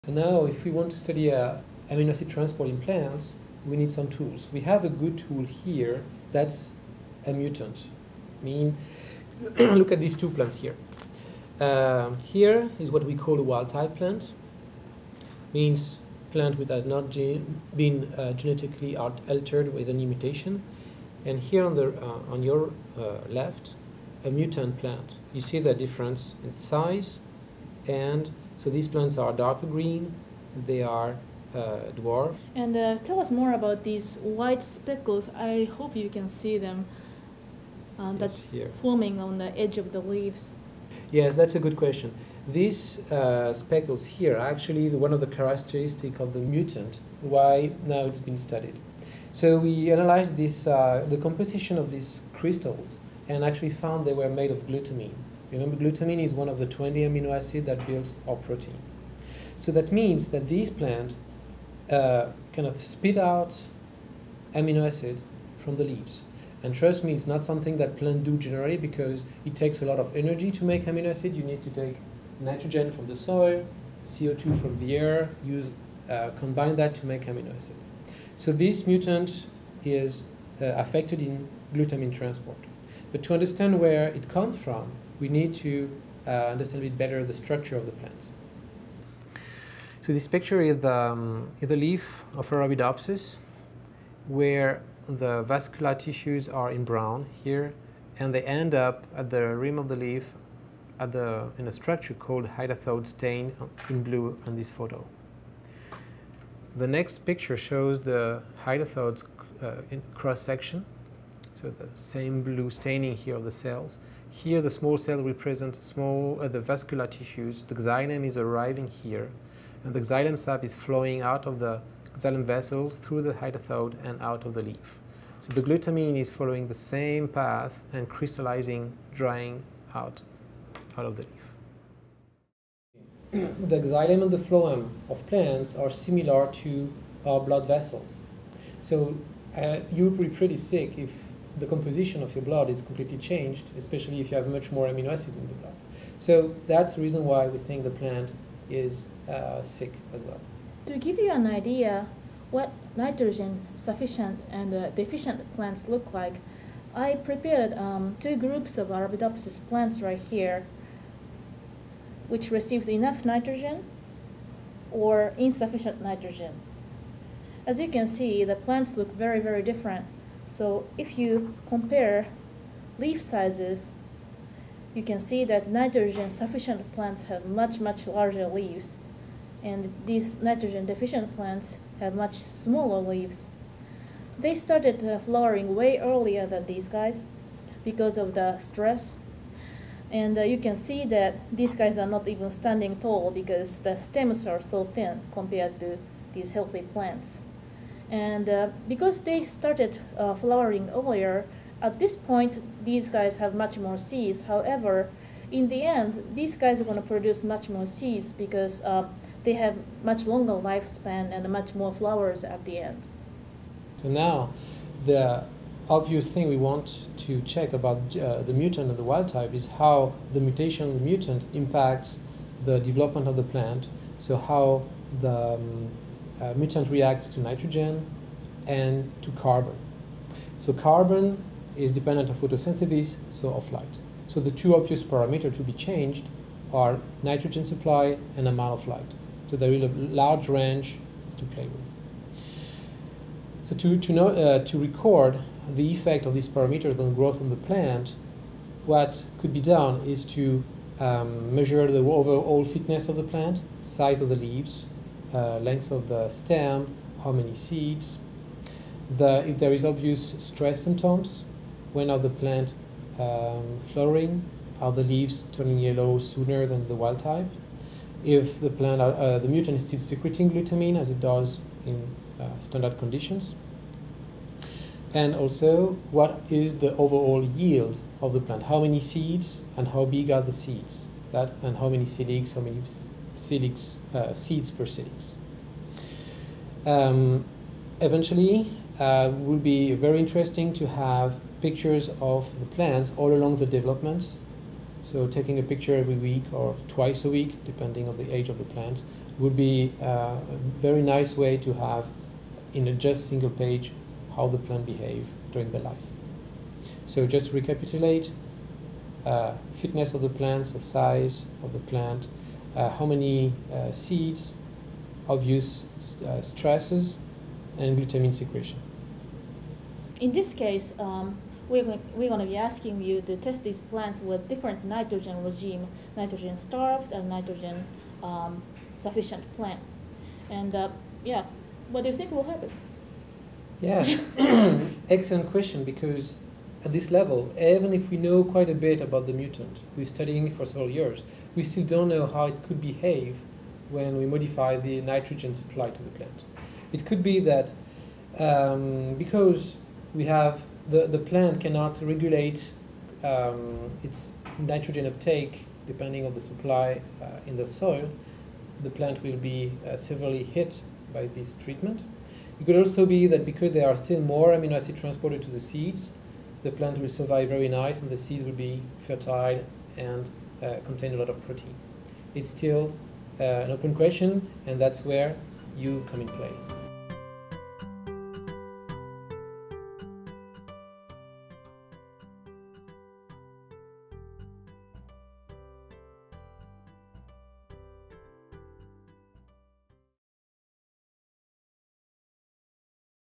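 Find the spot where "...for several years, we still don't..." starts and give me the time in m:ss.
5:40.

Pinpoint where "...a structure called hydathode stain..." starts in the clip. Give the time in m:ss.
1:41.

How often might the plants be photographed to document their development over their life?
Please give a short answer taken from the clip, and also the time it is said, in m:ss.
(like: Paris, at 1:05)
twice a week, at 4:56.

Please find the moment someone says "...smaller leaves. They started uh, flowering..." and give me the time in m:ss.
3:02.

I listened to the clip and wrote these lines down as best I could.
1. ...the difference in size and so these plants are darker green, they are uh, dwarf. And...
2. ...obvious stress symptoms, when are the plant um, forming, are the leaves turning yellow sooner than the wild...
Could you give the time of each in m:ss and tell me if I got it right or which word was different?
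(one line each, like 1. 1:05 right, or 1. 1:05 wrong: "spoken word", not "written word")
1. 0:25 right
2. 4:19 wrong: "flowering", not "forming".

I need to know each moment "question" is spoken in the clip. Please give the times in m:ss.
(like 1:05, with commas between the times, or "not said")
0:41, 5:35, 6:13.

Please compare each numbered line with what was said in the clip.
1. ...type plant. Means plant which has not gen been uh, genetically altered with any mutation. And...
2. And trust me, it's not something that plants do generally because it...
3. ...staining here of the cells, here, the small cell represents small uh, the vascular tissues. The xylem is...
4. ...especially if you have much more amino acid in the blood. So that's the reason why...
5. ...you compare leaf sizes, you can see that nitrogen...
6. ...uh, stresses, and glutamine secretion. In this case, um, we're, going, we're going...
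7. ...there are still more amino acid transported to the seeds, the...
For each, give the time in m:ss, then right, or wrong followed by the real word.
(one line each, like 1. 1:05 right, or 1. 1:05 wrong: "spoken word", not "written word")
1. 0:13 right
2. 1:06 right
3. 1:52 right
4. 2:23 right
5. 2:51 right
6. 5:16 right
7. 6:03 right.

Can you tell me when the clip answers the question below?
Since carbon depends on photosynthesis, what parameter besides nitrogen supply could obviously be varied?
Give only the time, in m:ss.
3:58.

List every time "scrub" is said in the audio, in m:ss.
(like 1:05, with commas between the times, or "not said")
not said.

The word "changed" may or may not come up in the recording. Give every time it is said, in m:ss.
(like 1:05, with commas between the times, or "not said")
2:23, 3:55.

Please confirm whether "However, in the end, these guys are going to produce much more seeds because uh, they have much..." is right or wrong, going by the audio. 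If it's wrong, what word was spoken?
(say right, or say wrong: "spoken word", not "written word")
right.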